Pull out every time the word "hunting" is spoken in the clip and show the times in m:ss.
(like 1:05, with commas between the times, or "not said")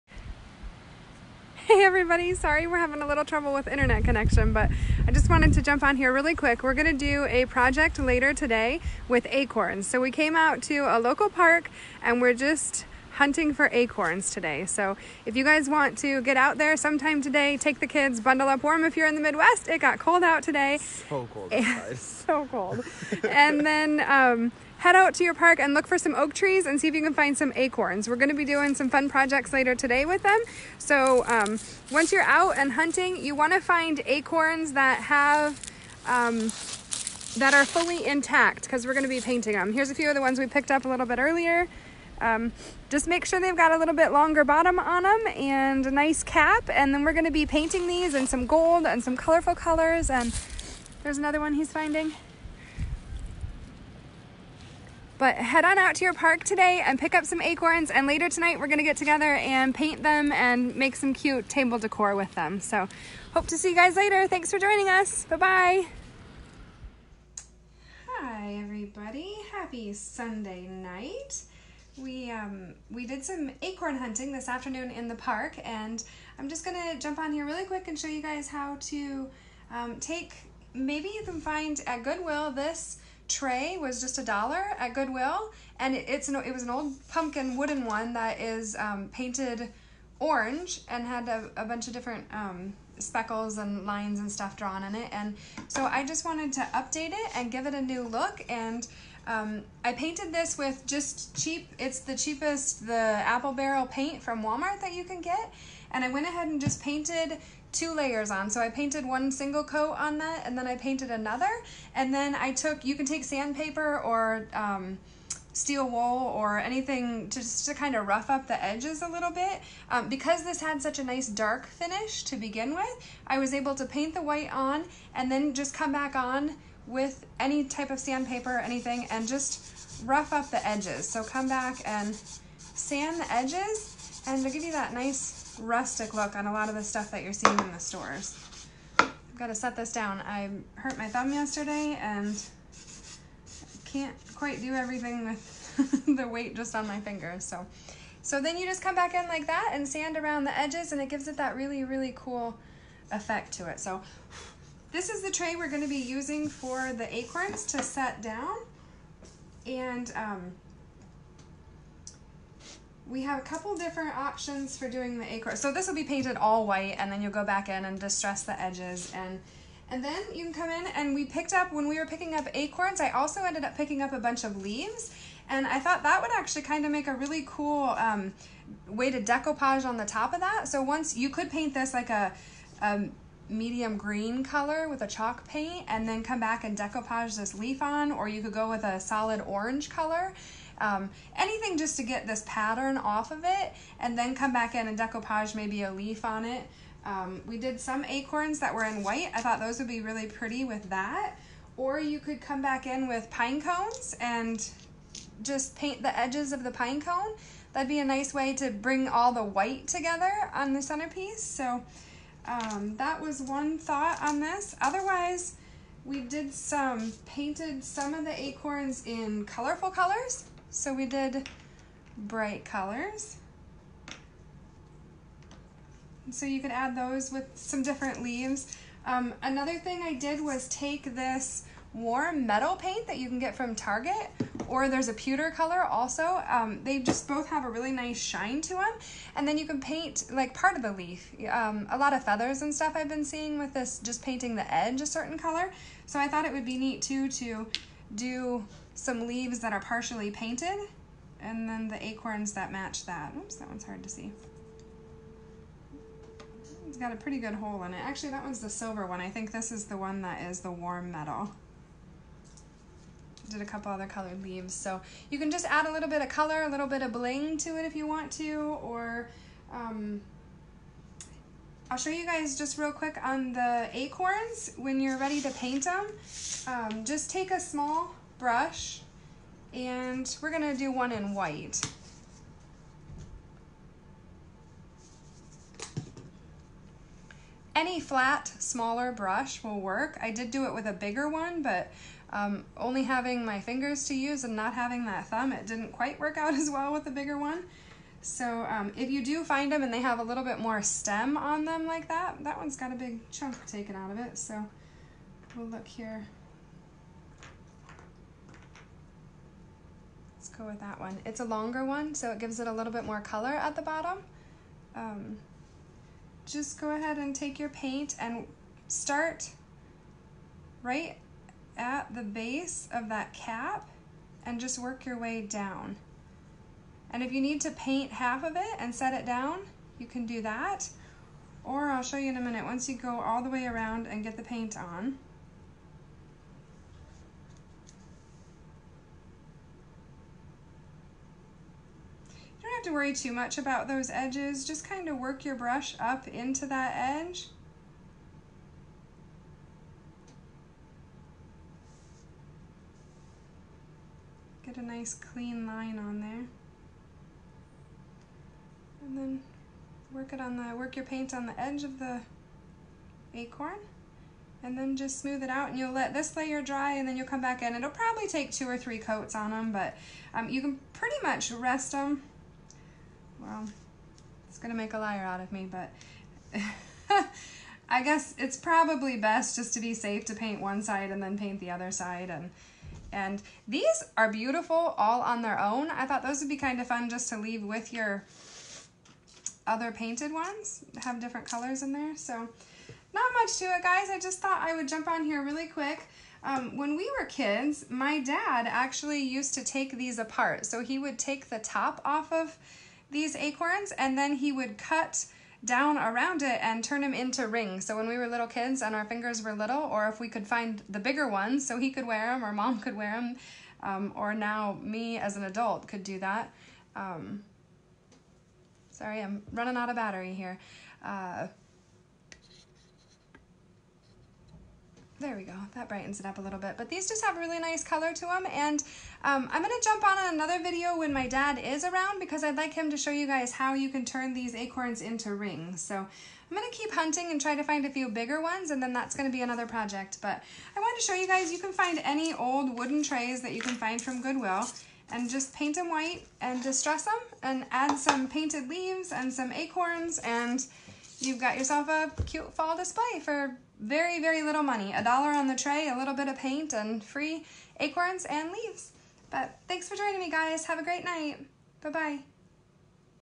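0:13, 0:32, 1:13, 7:16.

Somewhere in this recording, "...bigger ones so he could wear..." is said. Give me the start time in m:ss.
6:50.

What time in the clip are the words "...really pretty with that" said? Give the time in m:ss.
3:20.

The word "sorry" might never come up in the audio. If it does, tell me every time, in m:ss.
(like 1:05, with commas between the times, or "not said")
0:02, 6:58.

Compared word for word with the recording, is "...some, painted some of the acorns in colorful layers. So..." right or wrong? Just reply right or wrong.
wrong.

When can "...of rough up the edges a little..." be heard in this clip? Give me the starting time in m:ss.
1:57.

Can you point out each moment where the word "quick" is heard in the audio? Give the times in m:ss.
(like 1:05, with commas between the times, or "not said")
0:06, 1:17, 4:32, 6:35.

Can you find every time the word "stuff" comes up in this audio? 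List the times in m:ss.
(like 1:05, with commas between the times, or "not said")
1:34, 2:16, 4:02.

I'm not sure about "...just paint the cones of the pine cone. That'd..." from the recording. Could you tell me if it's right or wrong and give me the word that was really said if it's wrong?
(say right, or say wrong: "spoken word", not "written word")
wrong: "edges", not "cones".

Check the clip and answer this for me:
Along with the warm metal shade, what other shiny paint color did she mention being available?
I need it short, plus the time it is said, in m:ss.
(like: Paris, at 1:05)
Pewter, at 3:55.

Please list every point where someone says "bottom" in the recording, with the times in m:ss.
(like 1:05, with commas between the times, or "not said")
0:44, 5:13.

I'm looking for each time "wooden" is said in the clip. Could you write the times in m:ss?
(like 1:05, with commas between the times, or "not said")
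1:27, 7:22.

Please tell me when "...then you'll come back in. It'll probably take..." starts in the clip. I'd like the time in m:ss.
6:07.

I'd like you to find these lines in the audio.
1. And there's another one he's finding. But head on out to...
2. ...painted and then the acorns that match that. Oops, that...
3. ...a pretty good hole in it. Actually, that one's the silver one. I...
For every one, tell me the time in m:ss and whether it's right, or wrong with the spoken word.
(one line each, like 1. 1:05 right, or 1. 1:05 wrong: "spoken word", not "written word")
1. 0:50 right
2. 4:10 right
3. 4:17 right.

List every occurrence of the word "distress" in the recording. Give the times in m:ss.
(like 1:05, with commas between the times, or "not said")
2:47, 7:26.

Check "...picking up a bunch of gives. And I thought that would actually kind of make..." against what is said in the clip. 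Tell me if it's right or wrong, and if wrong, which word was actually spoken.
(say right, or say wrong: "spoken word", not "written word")
wrong: "leaves", not "gives".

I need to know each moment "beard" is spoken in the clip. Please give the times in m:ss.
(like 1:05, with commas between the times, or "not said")
not said.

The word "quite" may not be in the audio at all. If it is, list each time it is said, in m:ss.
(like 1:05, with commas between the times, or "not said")
2:24, 4:55.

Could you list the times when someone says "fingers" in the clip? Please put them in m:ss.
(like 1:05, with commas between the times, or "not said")
2:27, 4:53, 6:49.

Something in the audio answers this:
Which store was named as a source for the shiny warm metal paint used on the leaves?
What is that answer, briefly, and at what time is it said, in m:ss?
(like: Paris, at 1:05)
Target, at 3:53.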